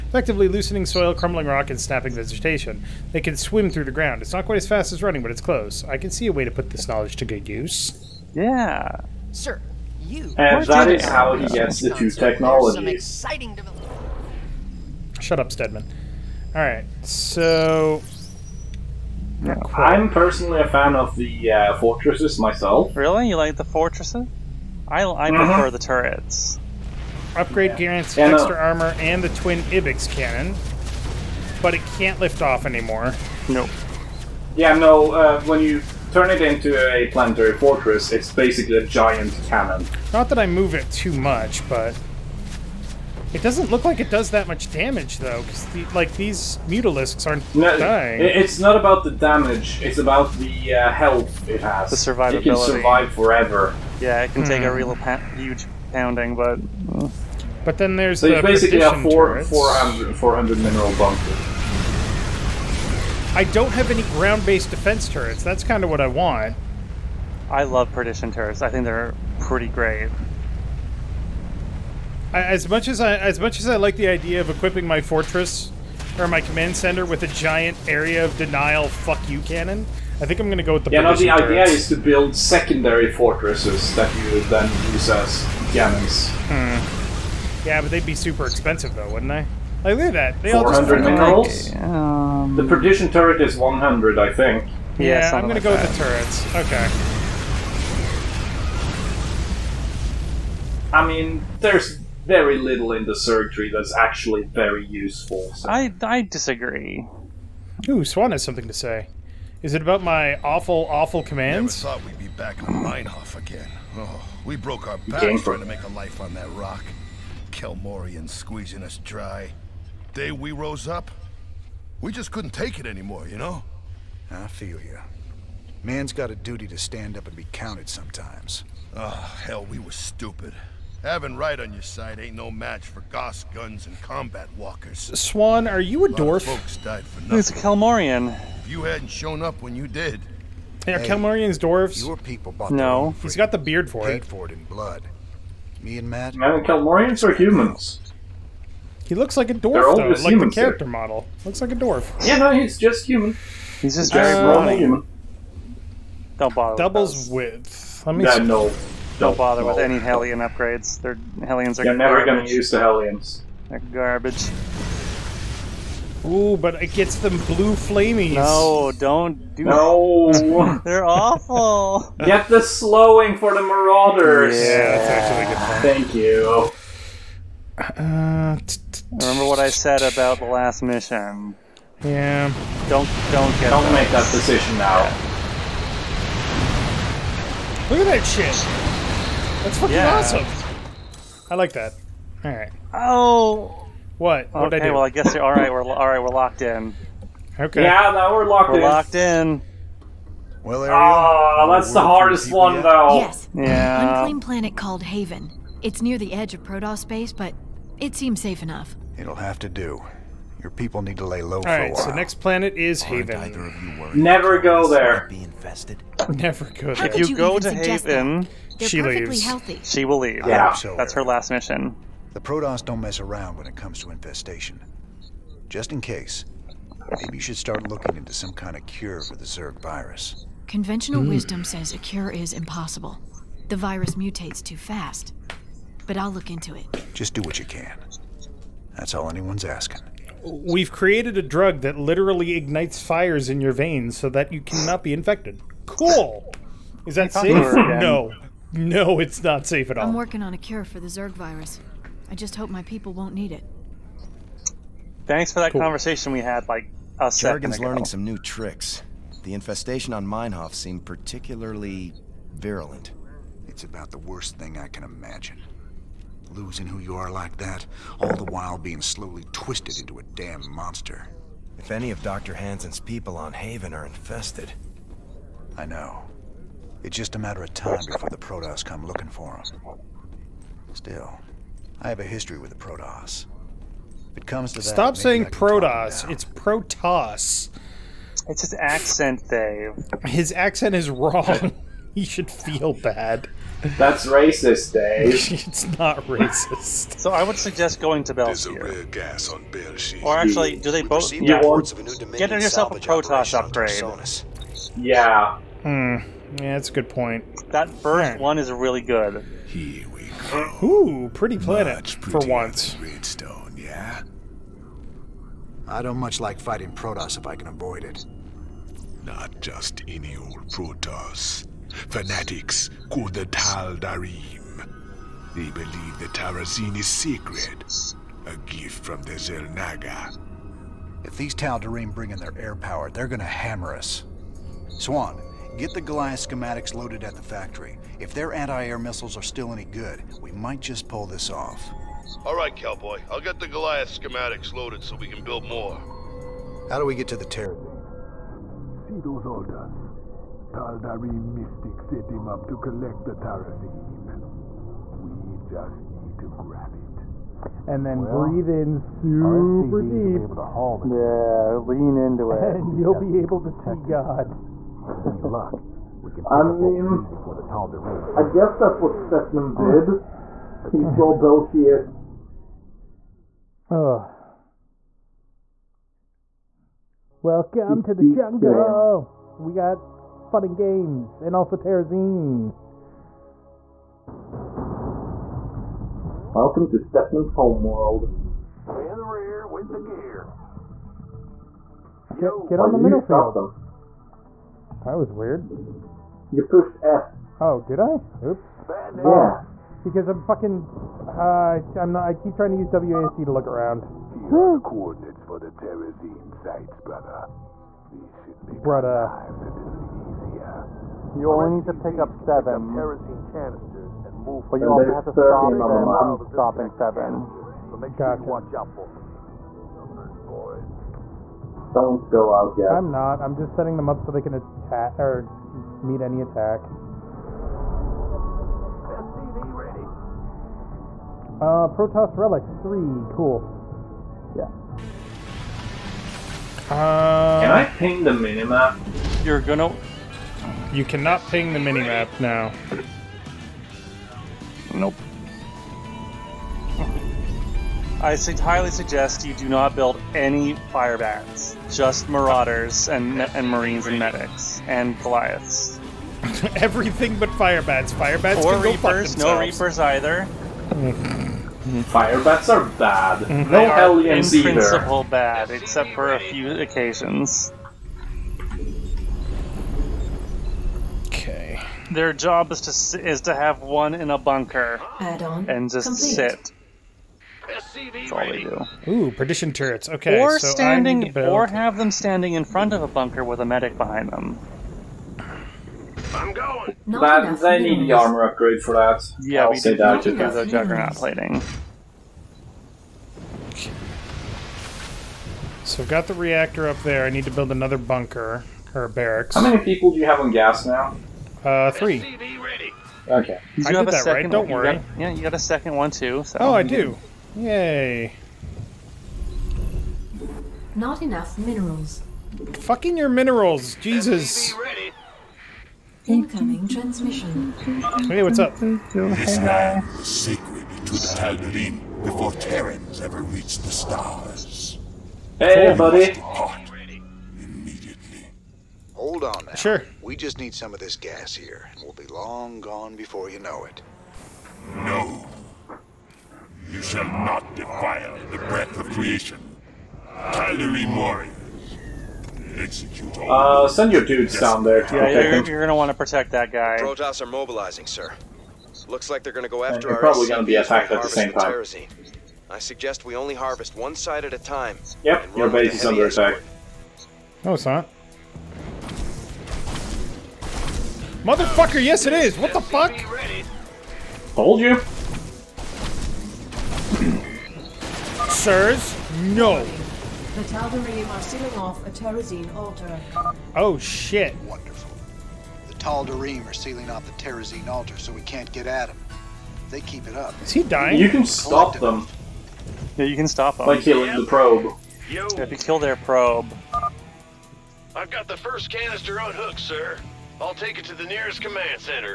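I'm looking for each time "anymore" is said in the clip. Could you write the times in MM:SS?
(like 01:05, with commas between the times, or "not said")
00:32, 02:02.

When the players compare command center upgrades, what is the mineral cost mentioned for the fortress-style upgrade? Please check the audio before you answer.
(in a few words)
400 minerals.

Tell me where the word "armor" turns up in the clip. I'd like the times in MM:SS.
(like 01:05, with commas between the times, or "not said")
00:28, 08:08.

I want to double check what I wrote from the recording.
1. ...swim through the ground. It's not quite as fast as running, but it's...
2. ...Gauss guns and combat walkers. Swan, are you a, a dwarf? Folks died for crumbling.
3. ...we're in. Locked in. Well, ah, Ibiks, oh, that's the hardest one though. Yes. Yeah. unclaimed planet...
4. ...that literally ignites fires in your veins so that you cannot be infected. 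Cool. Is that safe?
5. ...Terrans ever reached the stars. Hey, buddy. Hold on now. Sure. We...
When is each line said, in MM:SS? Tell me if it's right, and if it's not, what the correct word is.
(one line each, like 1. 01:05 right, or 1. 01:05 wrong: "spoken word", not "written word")
1. 00:03 right
2. 02:13 wrong: "nothing", not "crumbling"
3. 03:18 wrong: "Ariel", not "Ibiks"
4. 04:01 right
5. 08:42 right.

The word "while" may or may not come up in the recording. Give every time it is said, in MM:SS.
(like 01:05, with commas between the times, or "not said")
03:31, 04:28.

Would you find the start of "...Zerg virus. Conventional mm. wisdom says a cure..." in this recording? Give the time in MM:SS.
03:49.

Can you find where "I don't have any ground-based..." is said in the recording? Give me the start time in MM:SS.
01:03.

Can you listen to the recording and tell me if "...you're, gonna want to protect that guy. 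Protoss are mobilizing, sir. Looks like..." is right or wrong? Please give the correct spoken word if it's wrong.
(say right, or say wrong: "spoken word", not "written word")
right.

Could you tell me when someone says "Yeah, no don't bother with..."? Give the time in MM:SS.
02:38.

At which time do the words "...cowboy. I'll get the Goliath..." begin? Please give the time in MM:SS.
05:42.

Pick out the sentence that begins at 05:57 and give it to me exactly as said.
And then well, breathe in super deep.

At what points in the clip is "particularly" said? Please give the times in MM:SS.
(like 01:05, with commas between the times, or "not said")
04:21.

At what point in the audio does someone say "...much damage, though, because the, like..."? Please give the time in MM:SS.
00:44.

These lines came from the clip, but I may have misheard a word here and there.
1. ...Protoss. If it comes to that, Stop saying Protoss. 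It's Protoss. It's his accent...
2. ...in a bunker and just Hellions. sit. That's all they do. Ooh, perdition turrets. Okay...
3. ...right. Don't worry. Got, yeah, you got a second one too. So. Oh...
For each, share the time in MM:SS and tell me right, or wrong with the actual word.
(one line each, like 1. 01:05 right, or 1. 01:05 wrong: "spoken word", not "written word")
1. 04:42 right
2. 07:54 wrong: "Complete", not "Hellions"
3. 08:24 right.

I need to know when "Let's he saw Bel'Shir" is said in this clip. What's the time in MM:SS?
06:10.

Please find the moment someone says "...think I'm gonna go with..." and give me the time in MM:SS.
01:20.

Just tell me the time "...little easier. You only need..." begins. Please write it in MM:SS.
06:49.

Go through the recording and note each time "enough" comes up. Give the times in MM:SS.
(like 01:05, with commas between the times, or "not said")
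03:28, 08:31.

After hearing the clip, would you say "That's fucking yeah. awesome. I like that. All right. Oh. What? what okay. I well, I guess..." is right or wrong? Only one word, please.
right.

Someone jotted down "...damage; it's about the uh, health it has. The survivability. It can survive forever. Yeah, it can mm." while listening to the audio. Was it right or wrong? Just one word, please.
right.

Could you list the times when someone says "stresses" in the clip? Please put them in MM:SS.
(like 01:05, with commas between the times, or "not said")
not said.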